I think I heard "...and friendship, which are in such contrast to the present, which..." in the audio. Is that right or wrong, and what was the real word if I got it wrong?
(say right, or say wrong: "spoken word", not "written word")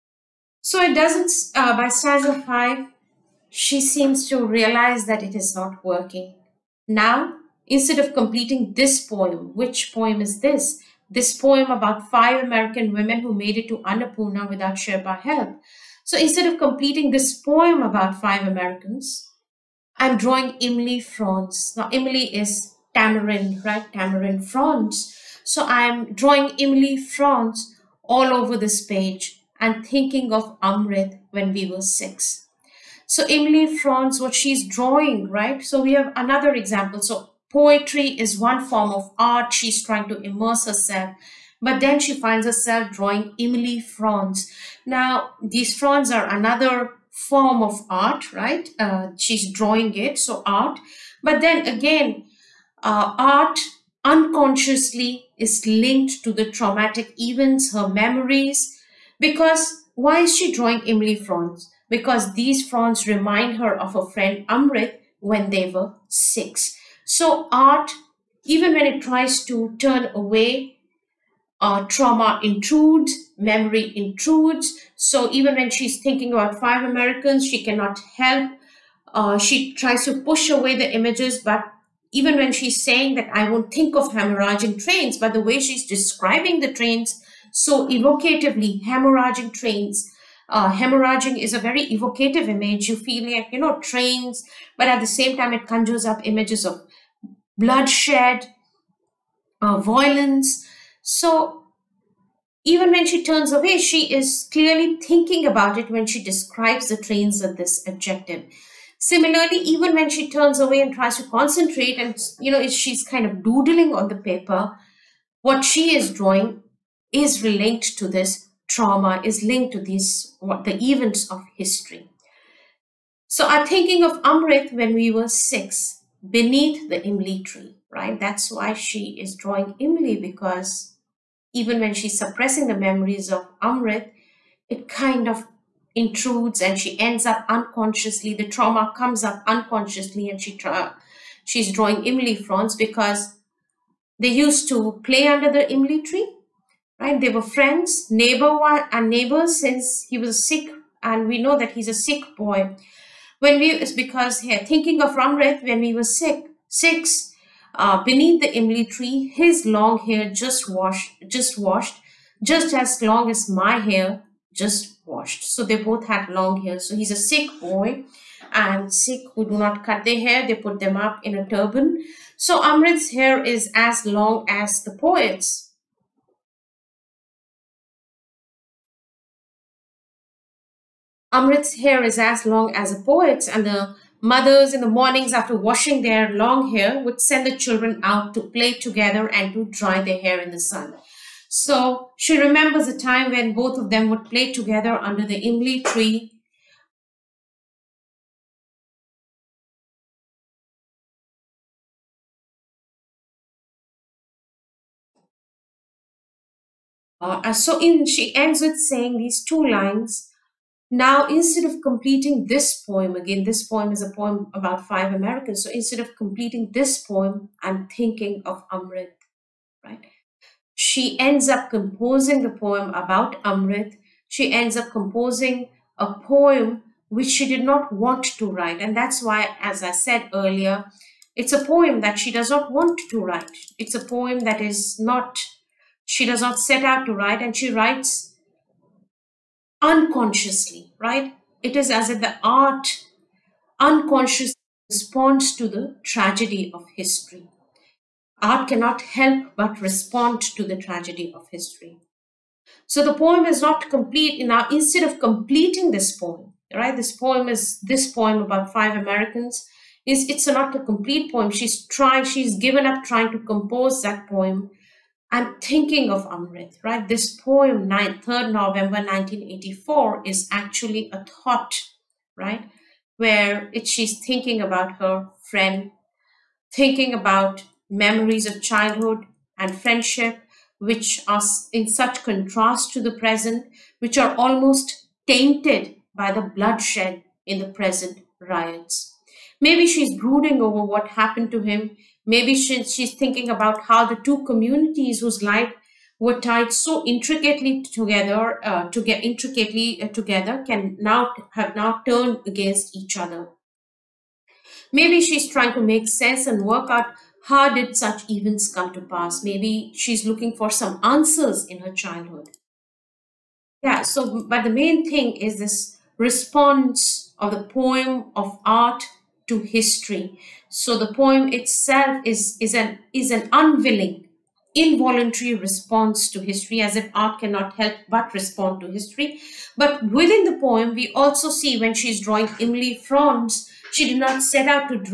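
right.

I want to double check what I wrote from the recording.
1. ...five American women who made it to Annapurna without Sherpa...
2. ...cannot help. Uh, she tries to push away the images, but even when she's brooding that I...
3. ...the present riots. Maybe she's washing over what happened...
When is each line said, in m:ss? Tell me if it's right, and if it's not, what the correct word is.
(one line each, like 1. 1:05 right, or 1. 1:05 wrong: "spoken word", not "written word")
1. 0:12 right
2. 1:17 wrong: "saying", not "brooding"
3. 4:47 wrong: "brooding", not "washing".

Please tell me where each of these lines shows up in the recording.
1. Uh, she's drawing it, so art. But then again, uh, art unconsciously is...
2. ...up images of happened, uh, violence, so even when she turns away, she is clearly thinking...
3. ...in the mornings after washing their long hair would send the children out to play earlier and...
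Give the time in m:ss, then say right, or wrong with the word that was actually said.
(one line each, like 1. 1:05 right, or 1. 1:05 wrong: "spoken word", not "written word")
1. 0:48 right
2. 1:36 wrong: "bloodshed", not "happened"
3. 3:04 wrong: "together", not "earlier".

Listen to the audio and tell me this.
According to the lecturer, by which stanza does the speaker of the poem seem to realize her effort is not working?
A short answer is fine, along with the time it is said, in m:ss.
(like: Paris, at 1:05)
stanza five, at 0:01.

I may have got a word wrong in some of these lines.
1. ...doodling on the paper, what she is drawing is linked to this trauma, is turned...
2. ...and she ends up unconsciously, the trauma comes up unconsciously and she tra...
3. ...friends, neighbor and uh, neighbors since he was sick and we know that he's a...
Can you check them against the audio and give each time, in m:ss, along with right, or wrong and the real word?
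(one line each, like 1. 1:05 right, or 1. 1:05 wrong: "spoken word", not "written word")
1. 1:53 wrong: "linked", not "turned"
2. 2:16 right
3. 2:27 right.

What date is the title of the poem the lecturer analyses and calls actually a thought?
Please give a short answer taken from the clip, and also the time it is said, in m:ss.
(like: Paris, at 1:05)
3rd November 1984, at 4:27.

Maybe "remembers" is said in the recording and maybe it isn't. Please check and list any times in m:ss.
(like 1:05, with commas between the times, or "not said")
3:12.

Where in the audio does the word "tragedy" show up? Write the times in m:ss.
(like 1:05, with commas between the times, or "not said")
4:06, 4:10.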